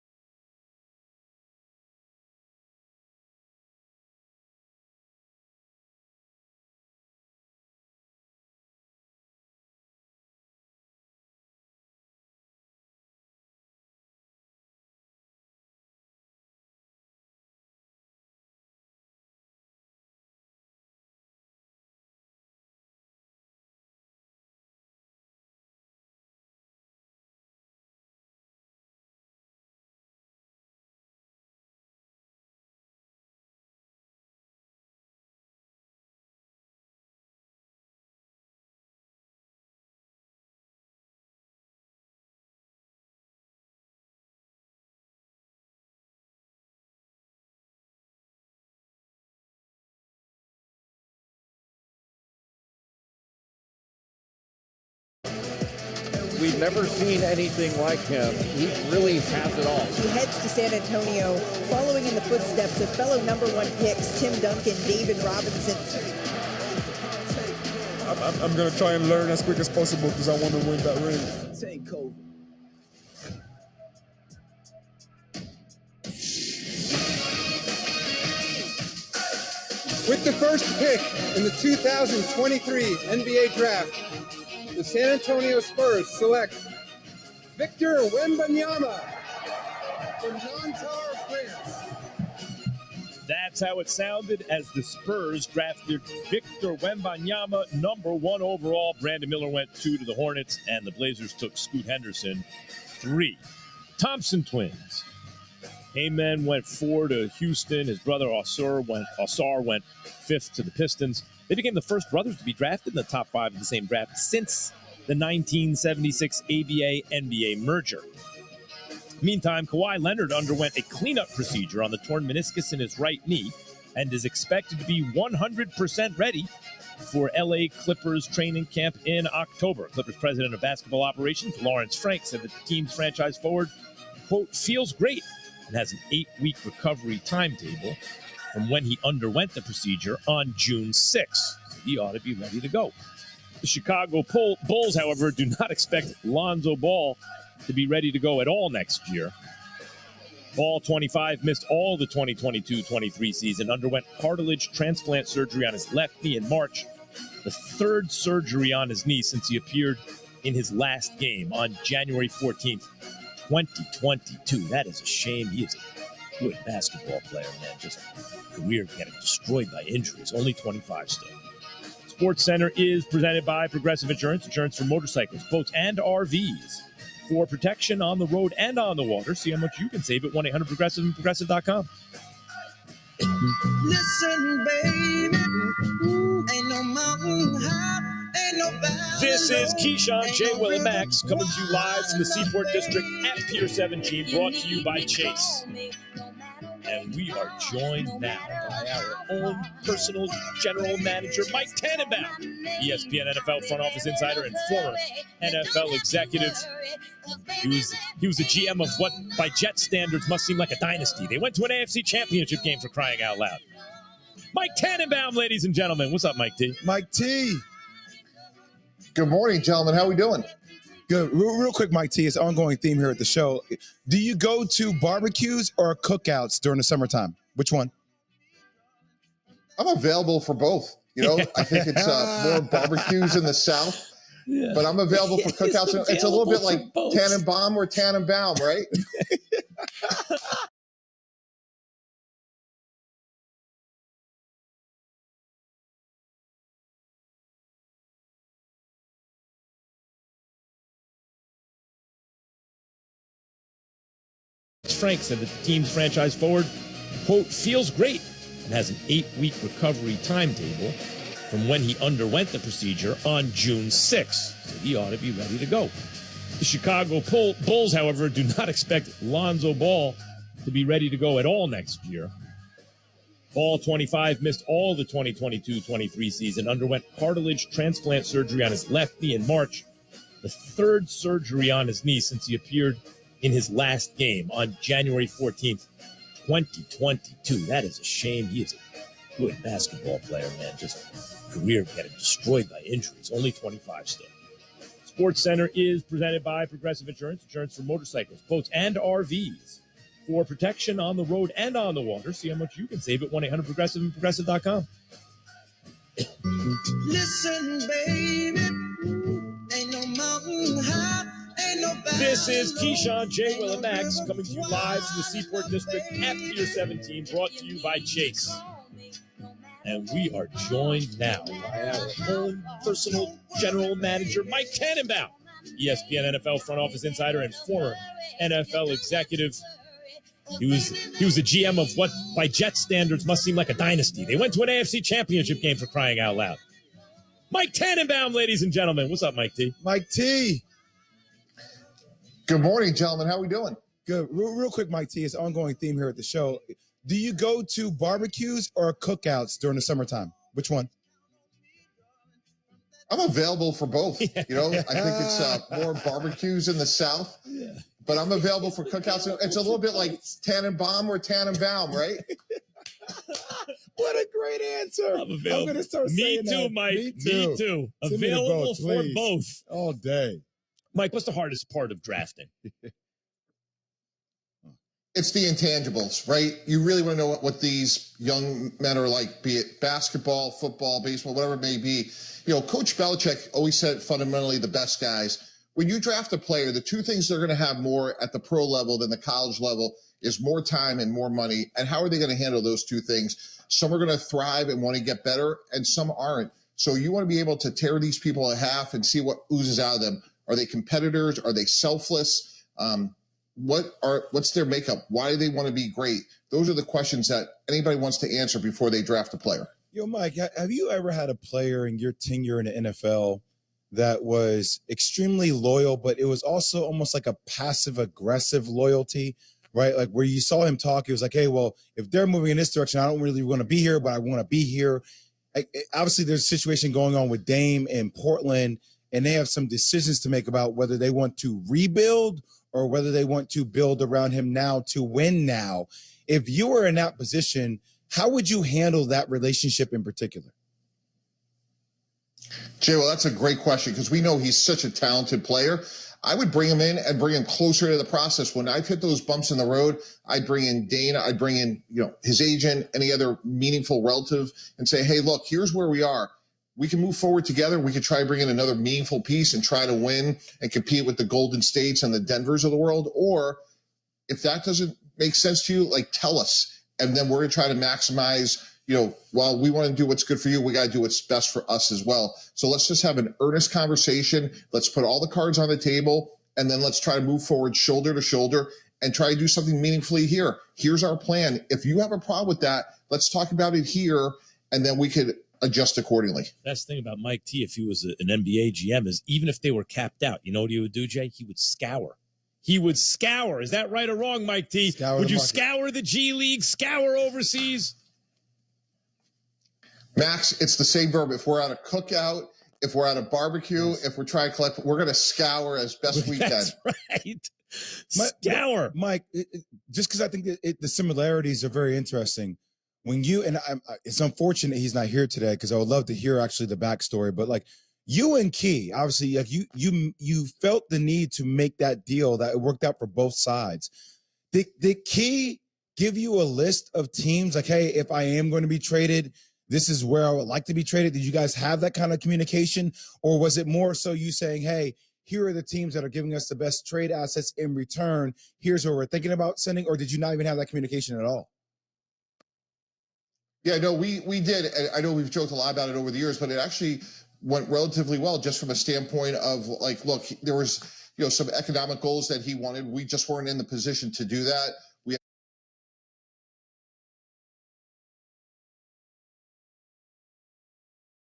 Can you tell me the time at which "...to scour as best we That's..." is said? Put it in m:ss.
8:25.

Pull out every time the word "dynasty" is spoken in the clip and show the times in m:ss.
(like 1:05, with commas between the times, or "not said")
3:30, 5:33.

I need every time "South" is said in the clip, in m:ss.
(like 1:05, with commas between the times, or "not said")
3:53, 5:56.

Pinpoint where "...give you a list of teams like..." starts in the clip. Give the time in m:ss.
8:45.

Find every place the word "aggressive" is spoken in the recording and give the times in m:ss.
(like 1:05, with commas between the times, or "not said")
6:57.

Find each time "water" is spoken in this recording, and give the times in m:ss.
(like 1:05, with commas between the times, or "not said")
2:59, 5:02.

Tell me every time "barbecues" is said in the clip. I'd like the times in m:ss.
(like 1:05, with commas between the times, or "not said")
3:45, 3:52, 5:47, 5:55, 8:23.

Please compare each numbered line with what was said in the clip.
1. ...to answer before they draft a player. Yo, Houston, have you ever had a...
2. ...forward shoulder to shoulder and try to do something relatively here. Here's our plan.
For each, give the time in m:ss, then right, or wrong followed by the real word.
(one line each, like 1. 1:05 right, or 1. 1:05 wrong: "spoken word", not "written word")
1. 6:48 wrong: "Mike", not "Houston"
2. 7:57 wrong: "meaningfully", not "relatively".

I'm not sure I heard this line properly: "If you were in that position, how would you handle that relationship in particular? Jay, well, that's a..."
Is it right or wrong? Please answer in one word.
right.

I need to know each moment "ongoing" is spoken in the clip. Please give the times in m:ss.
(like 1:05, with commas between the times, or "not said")
3:42, 5:45.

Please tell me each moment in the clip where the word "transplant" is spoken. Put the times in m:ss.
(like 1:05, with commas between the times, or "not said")
2:34, 4:37.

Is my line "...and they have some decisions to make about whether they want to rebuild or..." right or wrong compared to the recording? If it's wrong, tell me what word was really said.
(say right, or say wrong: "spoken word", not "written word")
right.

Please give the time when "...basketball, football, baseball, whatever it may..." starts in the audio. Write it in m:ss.
6:19.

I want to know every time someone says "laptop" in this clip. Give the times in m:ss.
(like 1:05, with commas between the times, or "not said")
not said.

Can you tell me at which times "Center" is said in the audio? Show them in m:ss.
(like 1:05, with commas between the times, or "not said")
2:52, 4:55.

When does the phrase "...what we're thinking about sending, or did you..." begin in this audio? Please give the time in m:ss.
8:58.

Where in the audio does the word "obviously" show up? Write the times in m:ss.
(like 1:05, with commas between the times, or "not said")
7:05, 8:38.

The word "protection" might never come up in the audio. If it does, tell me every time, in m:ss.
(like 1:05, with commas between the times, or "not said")
2:57, 5:00.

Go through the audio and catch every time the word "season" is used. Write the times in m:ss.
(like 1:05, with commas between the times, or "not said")
2:33, 4:36.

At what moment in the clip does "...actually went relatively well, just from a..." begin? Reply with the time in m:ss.
9:06.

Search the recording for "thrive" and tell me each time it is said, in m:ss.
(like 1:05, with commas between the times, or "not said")
6:34.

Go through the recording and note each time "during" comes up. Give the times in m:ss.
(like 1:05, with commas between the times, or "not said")
3:46, 5:49.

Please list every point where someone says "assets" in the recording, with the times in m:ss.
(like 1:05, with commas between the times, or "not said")
8:57.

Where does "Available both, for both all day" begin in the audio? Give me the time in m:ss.
6:08.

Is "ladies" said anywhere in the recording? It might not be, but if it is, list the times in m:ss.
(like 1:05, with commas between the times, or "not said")
3:35, 5:38.